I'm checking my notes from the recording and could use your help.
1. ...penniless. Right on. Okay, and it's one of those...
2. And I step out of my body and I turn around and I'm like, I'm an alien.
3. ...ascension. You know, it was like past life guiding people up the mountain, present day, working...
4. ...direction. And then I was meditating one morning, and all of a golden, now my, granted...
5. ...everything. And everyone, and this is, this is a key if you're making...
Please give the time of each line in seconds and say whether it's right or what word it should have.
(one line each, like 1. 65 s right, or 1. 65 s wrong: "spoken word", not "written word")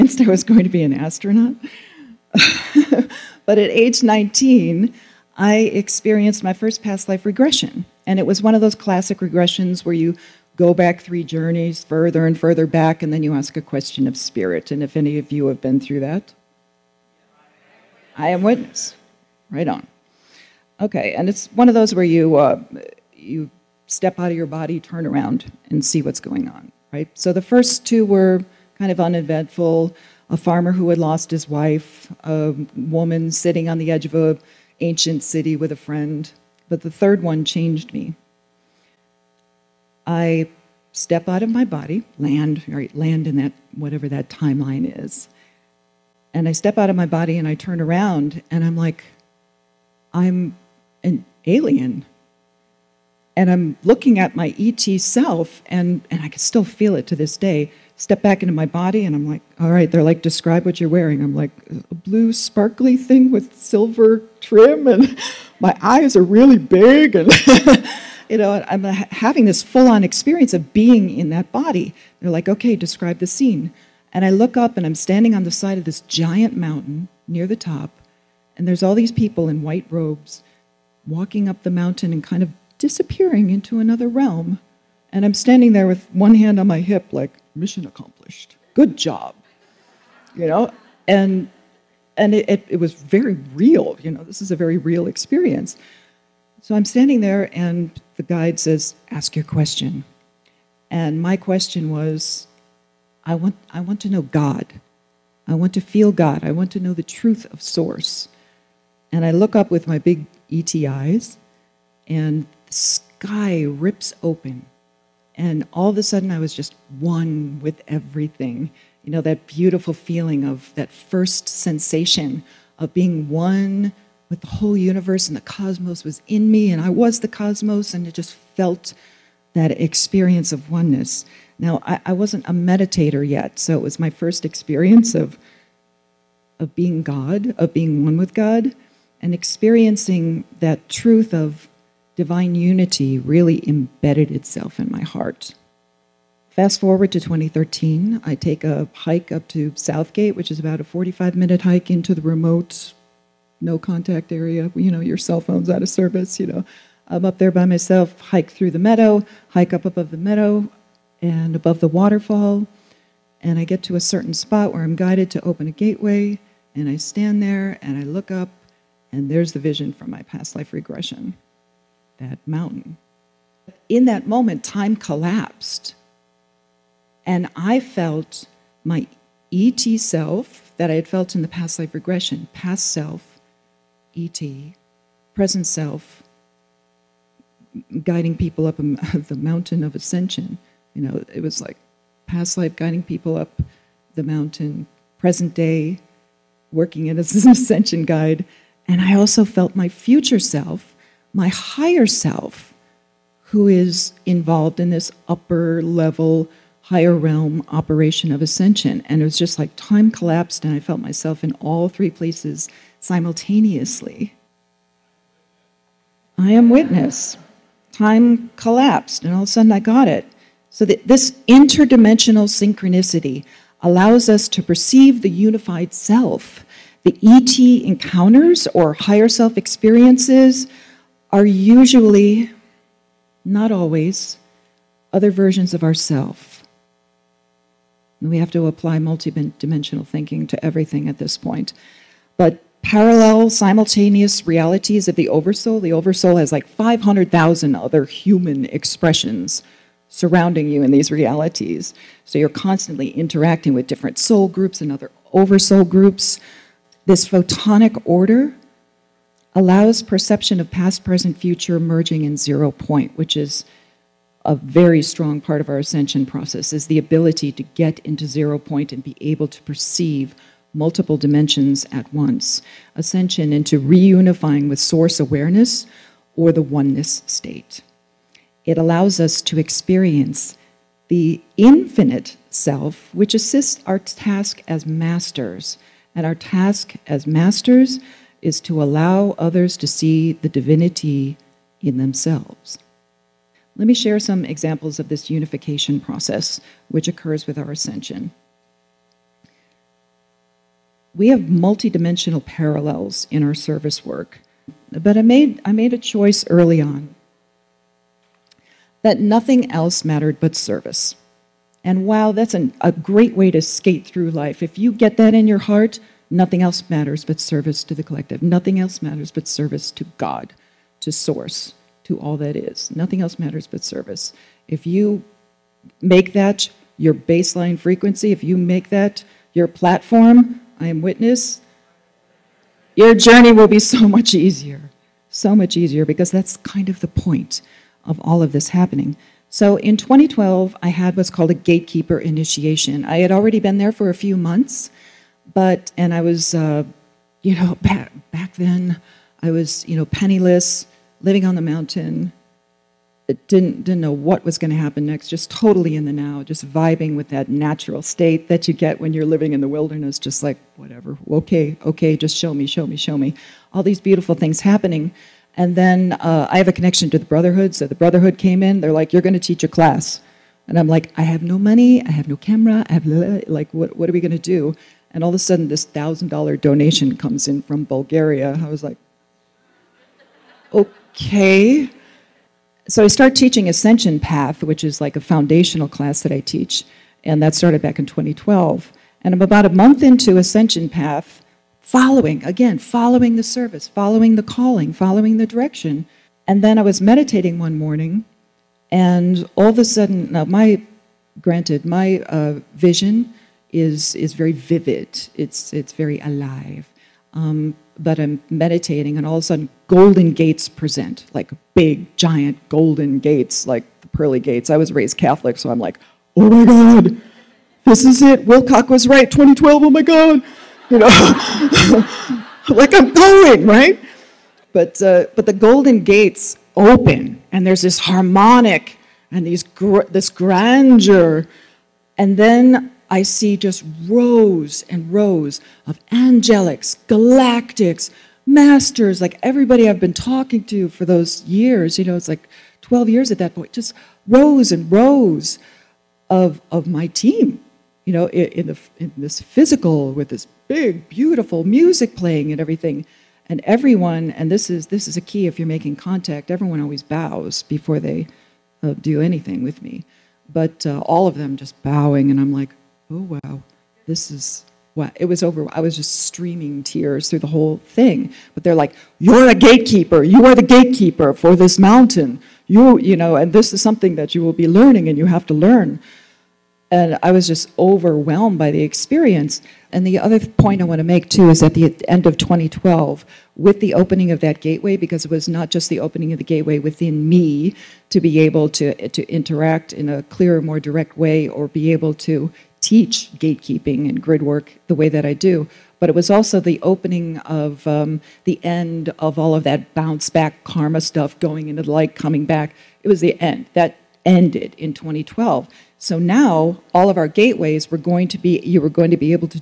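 1. 18 s wrong: "witness", not "penniless"
2. 46 s right
3. 189 s right
4. 395 s wrong: "sudden", not "golden"
5. 452 s right.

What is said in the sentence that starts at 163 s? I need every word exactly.
And I get to a certain spot where I'm guided to open a gateway.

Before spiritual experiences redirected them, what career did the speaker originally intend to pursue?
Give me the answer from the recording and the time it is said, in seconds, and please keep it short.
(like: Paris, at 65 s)
Astronaut, at 0 s.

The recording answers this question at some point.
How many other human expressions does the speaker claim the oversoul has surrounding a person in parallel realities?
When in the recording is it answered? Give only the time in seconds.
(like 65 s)
246 s.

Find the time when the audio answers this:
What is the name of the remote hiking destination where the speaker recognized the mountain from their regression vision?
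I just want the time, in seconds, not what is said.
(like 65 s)
149 s.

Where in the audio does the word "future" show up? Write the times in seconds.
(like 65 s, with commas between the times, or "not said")
199 s, 261 s.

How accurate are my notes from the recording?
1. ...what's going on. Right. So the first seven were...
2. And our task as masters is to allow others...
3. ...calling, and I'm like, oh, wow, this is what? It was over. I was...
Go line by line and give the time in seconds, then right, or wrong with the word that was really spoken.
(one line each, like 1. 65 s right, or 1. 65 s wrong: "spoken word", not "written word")
1. 26 s wrong: "two", not "seven"
2. 286 s right
3. 461 s wrong: "bowing", not "calling".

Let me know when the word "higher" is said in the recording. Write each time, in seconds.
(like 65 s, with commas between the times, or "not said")
201 s, 206 s, 228 s.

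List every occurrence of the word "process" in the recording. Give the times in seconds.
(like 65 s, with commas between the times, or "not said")
266 s, 295 s.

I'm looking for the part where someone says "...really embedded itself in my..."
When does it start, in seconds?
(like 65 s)
143 s.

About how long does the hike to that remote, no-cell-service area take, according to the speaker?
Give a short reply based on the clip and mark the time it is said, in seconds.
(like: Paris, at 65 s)
45 minutes, at 150 s.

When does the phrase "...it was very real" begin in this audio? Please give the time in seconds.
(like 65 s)
92 s.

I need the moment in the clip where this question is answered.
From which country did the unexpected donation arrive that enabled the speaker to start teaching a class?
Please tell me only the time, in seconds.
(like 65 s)
377 s.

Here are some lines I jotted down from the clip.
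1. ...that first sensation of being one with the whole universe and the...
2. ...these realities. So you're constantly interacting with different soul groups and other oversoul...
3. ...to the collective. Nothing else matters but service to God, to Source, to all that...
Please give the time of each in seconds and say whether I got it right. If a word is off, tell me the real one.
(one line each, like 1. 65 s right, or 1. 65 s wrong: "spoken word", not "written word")
1. 120 s right
2. 250 s right
3. 317 s right.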